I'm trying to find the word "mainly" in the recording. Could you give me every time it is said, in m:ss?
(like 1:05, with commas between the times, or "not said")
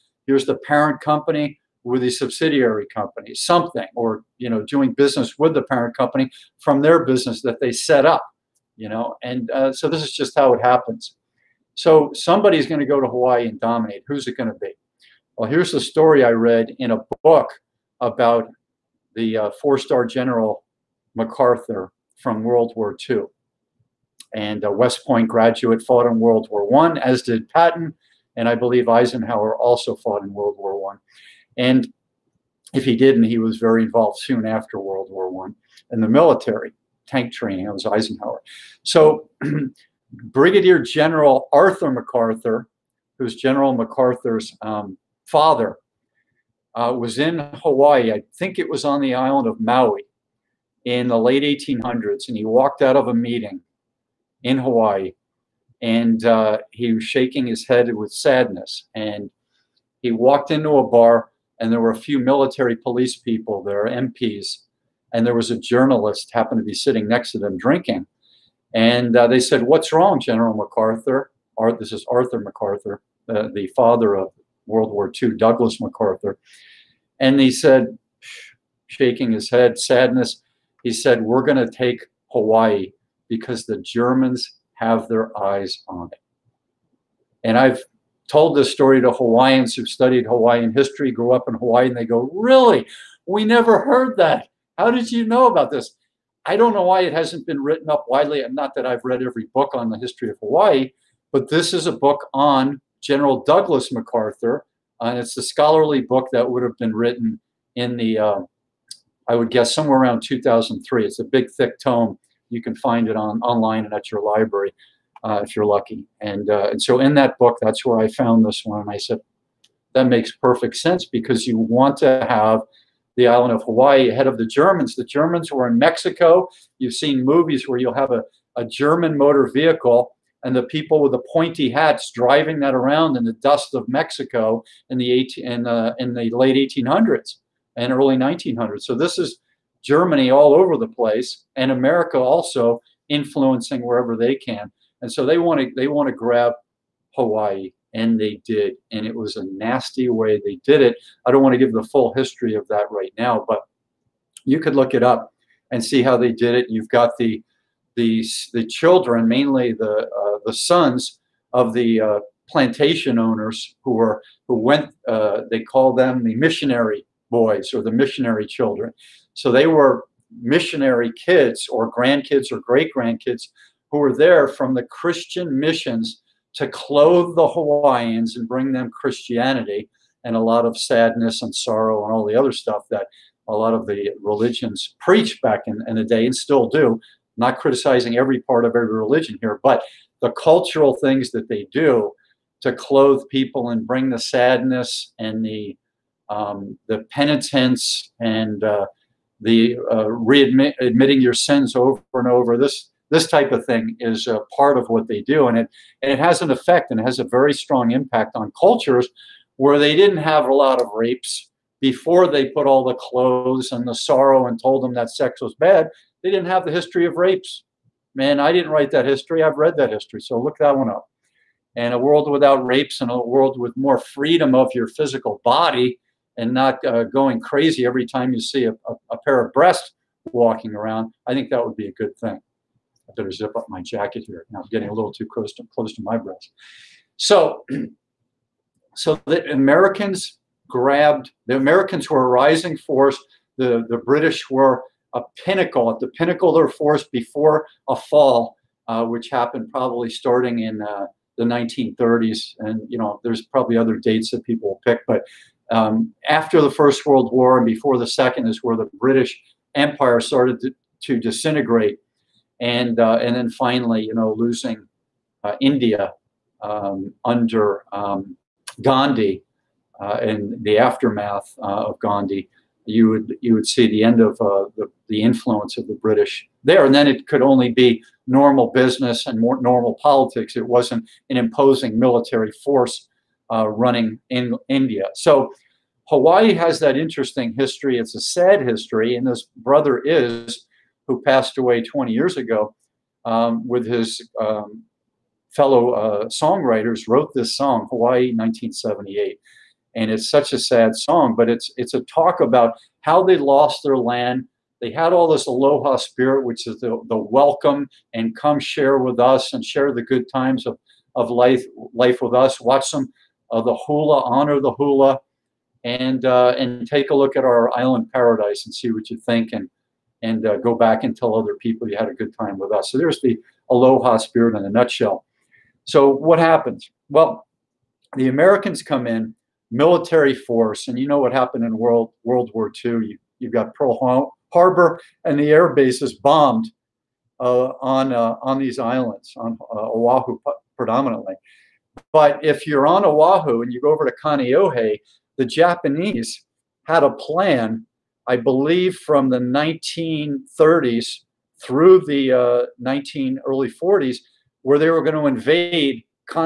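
2:39.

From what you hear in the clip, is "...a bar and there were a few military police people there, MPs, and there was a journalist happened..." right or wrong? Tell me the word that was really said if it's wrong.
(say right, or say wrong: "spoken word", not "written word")
right.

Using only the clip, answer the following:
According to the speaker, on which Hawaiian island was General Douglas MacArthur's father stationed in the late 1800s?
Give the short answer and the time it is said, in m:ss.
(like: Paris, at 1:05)
Maui, at 0:49.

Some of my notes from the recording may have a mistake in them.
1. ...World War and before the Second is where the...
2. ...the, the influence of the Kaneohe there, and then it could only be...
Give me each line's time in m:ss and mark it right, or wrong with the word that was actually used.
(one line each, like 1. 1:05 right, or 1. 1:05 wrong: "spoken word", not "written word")
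1. 4:17 right
2. 4:34 wrong: "British", not "Kaneohe".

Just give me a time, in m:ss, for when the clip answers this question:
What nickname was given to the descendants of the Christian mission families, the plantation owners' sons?
2:46.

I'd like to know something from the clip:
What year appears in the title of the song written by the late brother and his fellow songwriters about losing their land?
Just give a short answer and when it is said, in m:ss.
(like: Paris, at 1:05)
1978, at 4:58.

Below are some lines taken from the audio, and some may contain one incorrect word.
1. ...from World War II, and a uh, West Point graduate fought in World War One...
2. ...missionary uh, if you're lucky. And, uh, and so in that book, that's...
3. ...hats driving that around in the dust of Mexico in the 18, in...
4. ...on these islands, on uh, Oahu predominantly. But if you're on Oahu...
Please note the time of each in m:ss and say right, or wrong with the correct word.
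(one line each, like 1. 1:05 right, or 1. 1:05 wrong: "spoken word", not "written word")
1. 0:22 right
2. 1:54 wrong: "library", not "missionary"
3. 2:11 right
4. 5:38 right.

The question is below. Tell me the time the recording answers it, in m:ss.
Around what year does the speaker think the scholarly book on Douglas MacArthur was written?
1:50.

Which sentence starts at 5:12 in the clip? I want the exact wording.
Watch them the hula, honor the hula, and uh, and take a look at our island paradise and see what you think.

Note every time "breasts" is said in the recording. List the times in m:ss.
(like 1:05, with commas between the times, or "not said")
3:49, 3:56.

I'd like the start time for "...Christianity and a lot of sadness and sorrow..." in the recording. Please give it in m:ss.
2:58.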